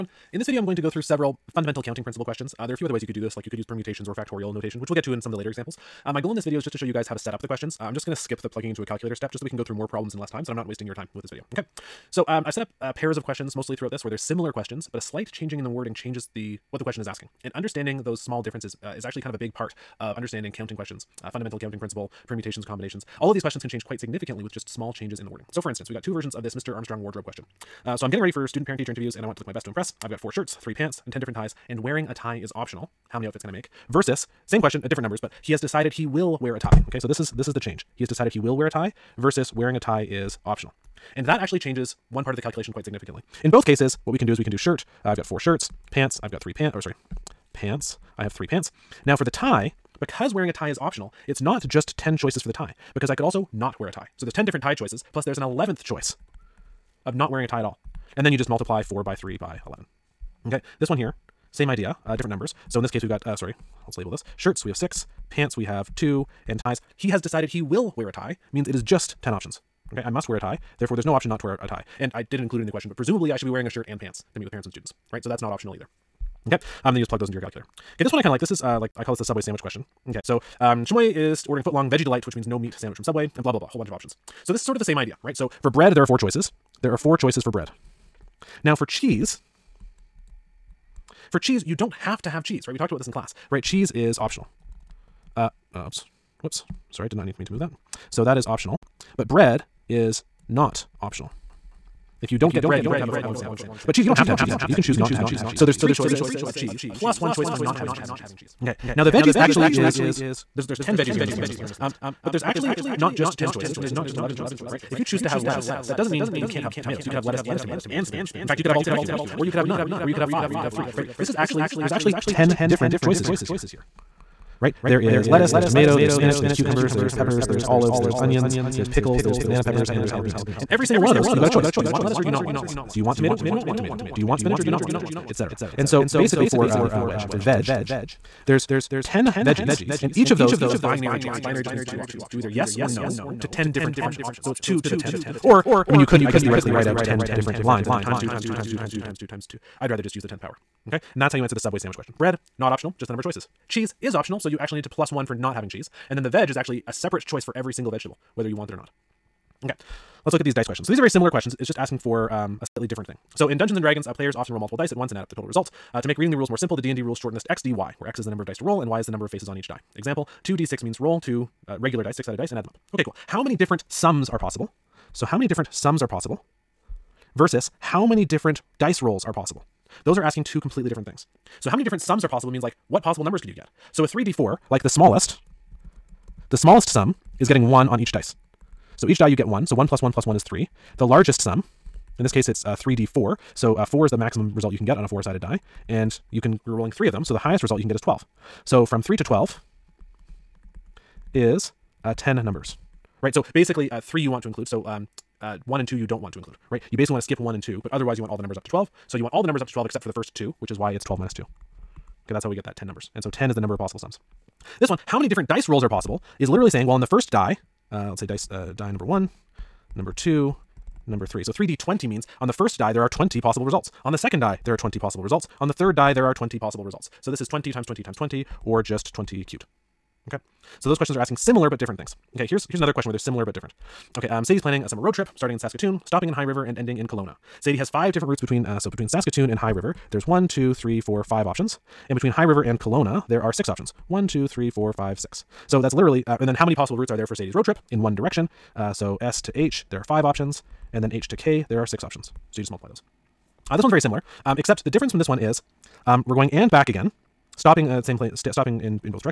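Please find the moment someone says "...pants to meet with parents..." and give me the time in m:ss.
1:13.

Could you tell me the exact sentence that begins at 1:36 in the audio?
Sorry, I did not need, mean to move that.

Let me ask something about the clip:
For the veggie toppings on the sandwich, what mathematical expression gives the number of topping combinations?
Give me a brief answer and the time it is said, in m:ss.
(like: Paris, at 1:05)
2 to the 10th, at 2:24.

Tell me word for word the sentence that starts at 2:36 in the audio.
And then the veg is actually a separate choice for every single vegetable, whether you want it or not.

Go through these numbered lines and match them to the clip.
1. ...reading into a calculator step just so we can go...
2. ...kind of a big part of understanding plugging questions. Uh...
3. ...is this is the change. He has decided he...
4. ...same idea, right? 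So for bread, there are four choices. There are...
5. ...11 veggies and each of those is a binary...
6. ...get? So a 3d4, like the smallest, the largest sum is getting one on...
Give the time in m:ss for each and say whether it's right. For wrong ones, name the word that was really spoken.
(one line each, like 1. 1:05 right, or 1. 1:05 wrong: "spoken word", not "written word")
1. 0:08 wrong: "plugging", not "reading"
2. 0:19 wrong: "counting", not "plugging"
3. 0:37 right
4. 1:24 right
5. 2:19 wrong: "10", not "11"
6. 3:03 wrong: "smallest", not "largest".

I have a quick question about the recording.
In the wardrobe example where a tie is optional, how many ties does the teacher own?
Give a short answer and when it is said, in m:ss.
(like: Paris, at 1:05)
10, at 0:31.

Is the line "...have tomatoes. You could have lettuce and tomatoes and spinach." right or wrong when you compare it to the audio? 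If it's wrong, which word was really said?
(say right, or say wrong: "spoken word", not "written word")
right.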